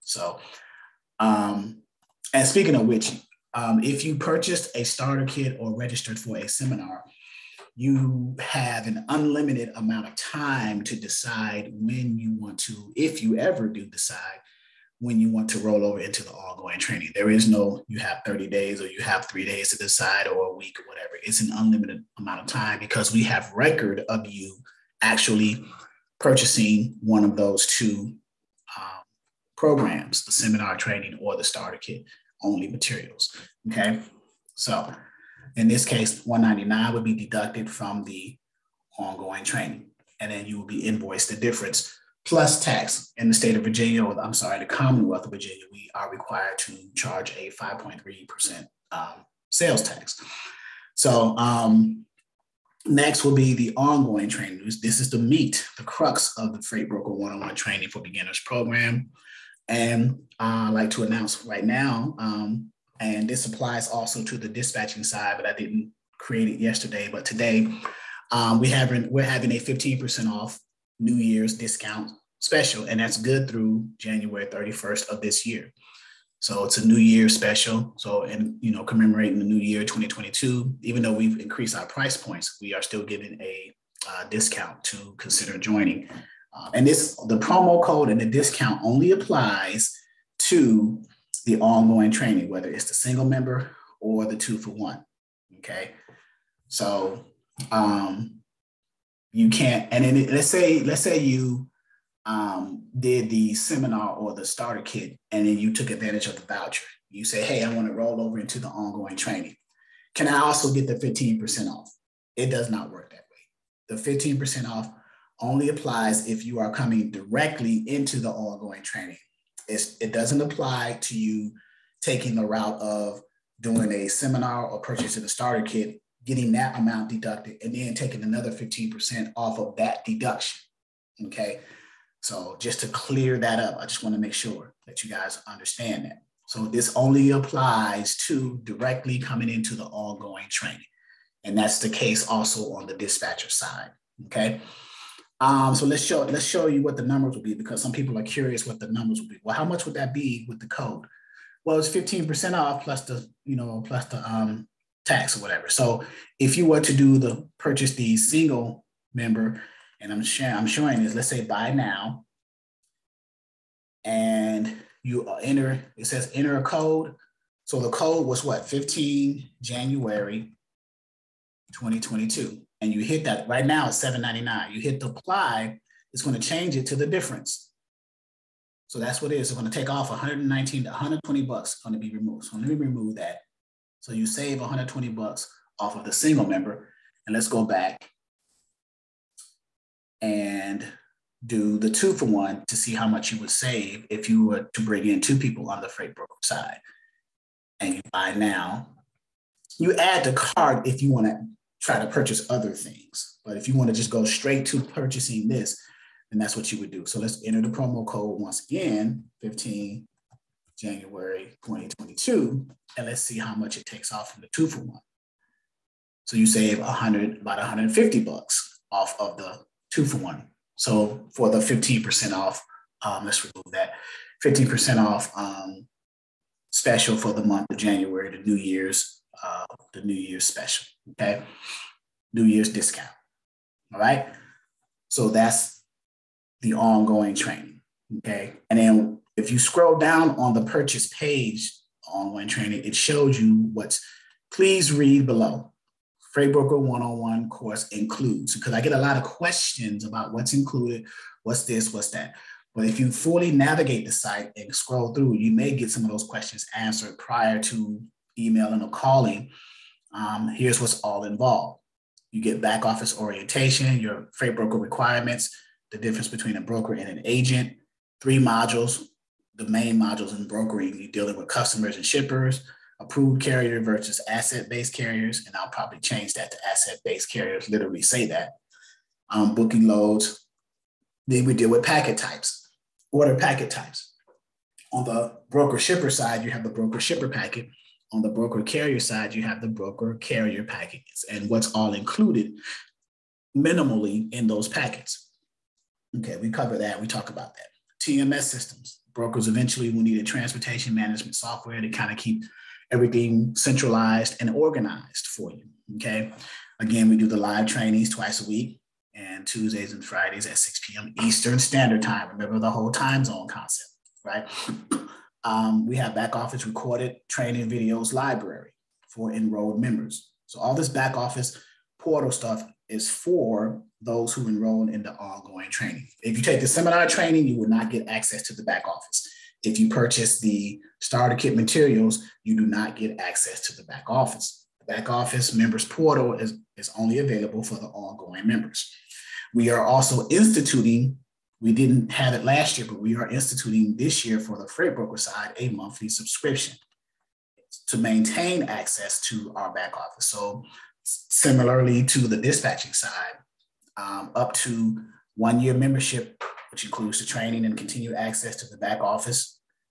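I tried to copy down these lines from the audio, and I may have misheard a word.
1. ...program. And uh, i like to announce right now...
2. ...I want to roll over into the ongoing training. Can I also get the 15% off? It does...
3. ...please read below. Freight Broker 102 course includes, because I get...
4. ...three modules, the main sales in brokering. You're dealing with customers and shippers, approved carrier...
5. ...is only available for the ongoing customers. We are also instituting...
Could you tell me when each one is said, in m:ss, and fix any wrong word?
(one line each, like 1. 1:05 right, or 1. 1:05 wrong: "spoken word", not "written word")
1. 0:58 right
2. 1:47 right
3. 4:04 wrong: "101", not "102"
4. 4:28 wrong: "modules", not "sales"
5. 5:36 wrong: "members", not "customers".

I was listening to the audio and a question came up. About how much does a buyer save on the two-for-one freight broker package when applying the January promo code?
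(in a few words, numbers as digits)
About 150 bucks.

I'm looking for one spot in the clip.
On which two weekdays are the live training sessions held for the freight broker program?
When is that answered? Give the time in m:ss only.
5:09.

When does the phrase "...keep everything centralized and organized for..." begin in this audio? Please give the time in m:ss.
5:02.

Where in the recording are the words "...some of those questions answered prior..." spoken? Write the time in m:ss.
4:15.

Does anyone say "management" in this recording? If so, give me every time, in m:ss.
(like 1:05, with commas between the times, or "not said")
5:00.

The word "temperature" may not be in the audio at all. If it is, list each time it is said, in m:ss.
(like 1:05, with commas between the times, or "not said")
not said.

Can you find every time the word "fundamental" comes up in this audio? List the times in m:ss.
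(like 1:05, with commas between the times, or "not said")
not said.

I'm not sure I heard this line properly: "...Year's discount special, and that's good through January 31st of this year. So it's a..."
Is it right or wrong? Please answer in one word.
right.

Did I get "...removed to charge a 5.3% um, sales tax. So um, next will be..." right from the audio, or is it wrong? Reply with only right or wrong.
wrong.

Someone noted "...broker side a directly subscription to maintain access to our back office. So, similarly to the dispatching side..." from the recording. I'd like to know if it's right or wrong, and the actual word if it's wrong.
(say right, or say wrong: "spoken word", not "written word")
wrong: "monthly", not "directly".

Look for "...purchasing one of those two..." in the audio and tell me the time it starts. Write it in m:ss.
0:26.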